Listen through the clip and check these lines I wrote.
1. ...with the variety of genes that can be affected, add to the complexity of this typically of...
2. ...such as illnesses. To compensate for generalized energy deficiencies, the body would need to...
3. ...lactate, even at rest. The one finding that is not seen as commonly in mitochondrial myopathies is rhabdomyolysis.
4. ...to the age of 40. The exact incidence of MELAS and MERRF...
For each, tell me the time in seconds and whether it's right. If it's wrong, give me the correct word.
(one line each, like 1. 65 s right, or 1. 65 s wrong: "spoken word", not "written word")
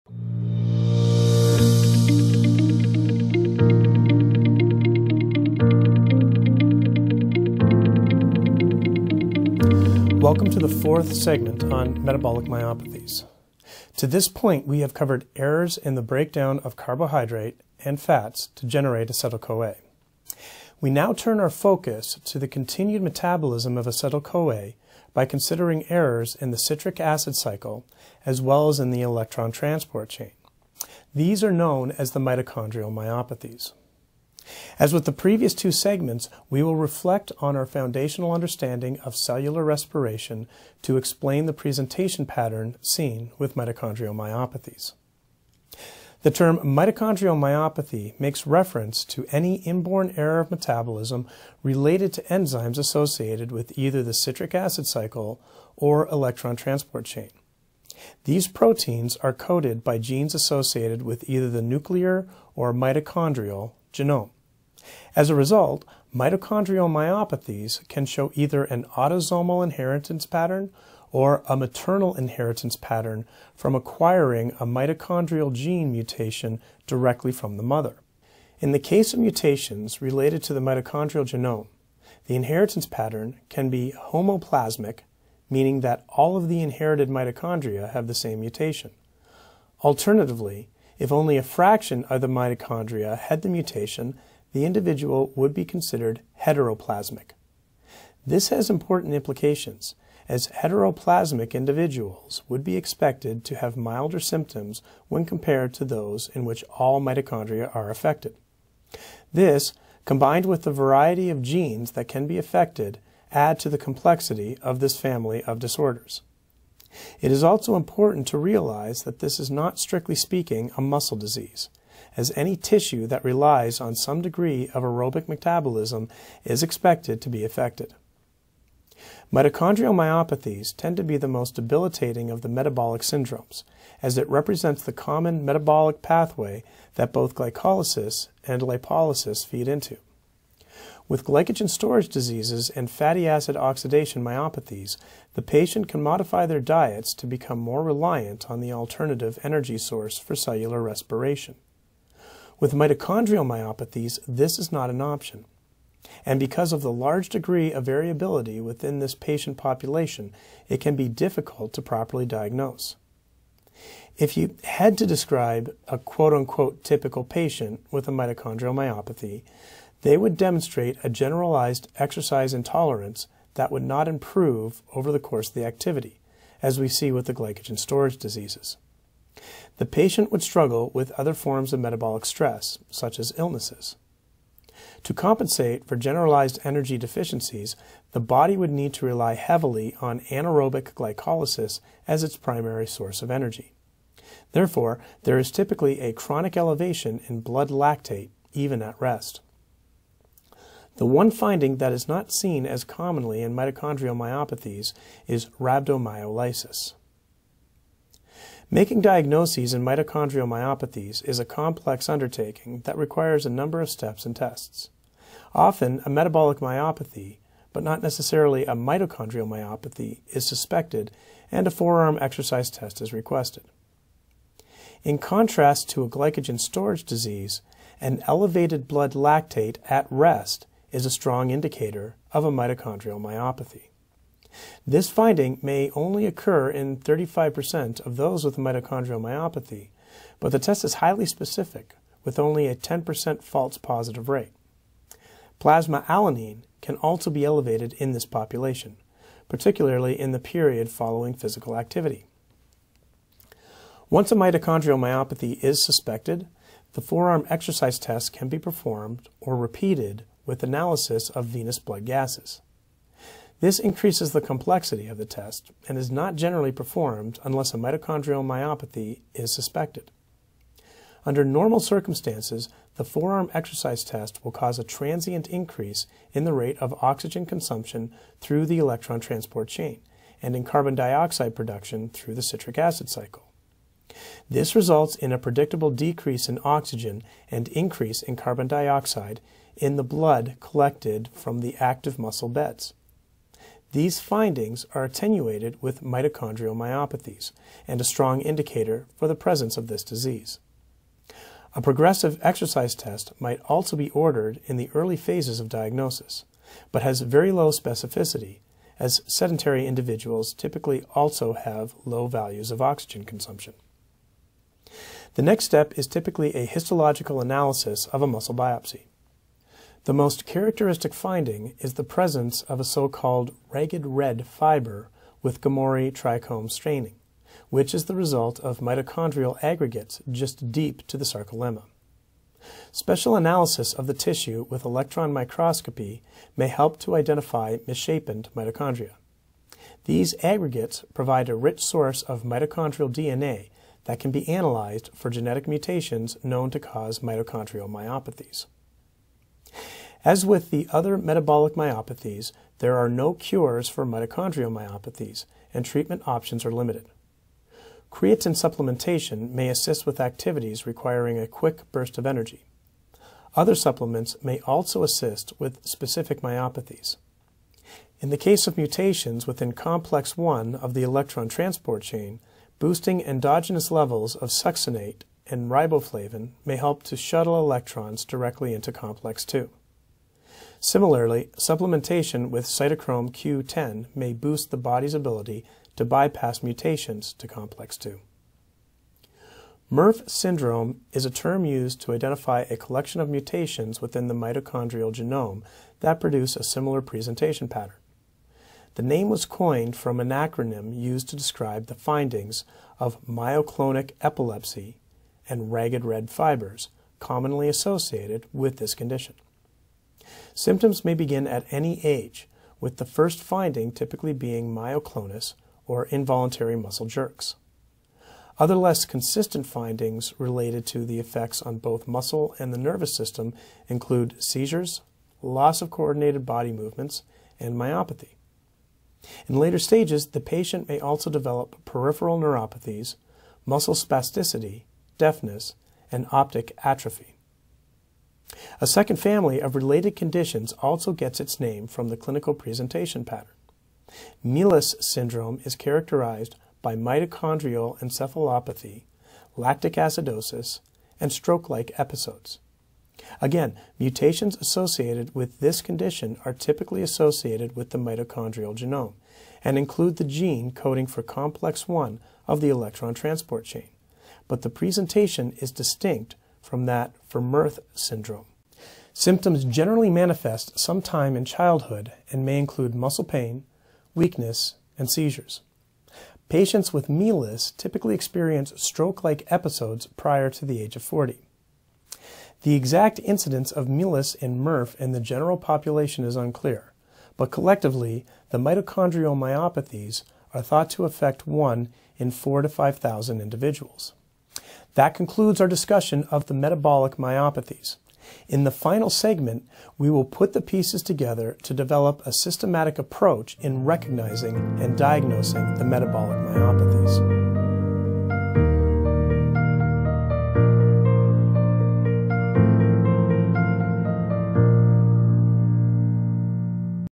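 1. 110 s wrong: "family", not "typically"
2. 182 s right
3. 197 s right
4. 480 s right.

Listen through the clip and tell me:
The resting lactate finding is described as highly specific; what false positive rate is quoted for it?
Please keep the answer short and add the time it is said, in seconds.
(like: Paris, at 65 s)
10%, at 242 s.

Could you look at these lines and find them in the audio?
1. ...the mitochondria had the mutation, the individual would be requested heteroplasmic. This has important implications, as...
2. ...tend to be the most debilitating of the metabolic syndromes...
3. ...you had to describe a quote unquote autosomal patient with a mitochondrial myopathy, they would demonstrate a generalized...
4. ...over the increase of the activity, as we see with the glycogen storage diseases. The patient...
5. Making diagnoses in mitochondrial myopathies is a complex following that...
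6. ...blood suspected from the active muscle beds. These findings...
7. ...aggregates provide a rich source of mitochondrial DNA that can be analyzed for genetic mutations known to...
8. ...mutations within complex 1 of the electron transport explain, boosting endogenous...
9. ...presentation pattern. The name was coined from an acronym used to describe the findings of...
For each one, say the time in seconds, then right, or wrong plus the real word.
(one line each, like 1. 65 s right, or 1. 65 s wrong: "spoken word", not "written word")
1. 92 s wrong: "considered", not "requested"
2. 130 s right
3. 164 s wrong: "typical", not "autosomal"
4. 174 s wrong: "course", not "increase"
5. 208 s wrong: "undertaking", not "following"
6. 290 s wrong: "collected", not "suspected"
7. 340 s right
8. 368 s wrong: "chain", not "explain"
9. 397 s right.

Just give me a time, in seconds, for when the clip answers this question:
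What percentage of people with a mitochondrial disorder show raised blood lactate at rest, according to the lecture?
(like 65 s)
236 s.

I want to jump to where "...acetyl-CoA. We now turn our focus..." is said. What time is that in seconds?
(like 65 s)
19 s.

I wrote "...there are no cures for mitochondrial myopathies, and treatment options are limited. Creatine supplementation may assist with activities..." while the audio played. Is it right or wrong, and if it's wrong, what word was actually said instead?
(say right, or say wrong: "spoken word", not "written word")
right.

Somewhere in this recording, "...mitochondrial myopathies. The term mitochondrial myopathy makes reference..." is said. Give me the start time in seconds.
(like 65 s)
43 s.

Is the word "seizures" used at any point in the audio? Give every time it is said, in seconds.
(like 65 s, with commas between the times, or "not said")
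424 s, 475 s.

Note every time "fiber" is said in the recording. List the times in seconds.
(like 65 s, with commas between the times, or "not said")
324 s, 406 s.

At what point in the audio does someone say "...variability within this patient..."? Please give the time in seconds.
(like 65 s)
157 s.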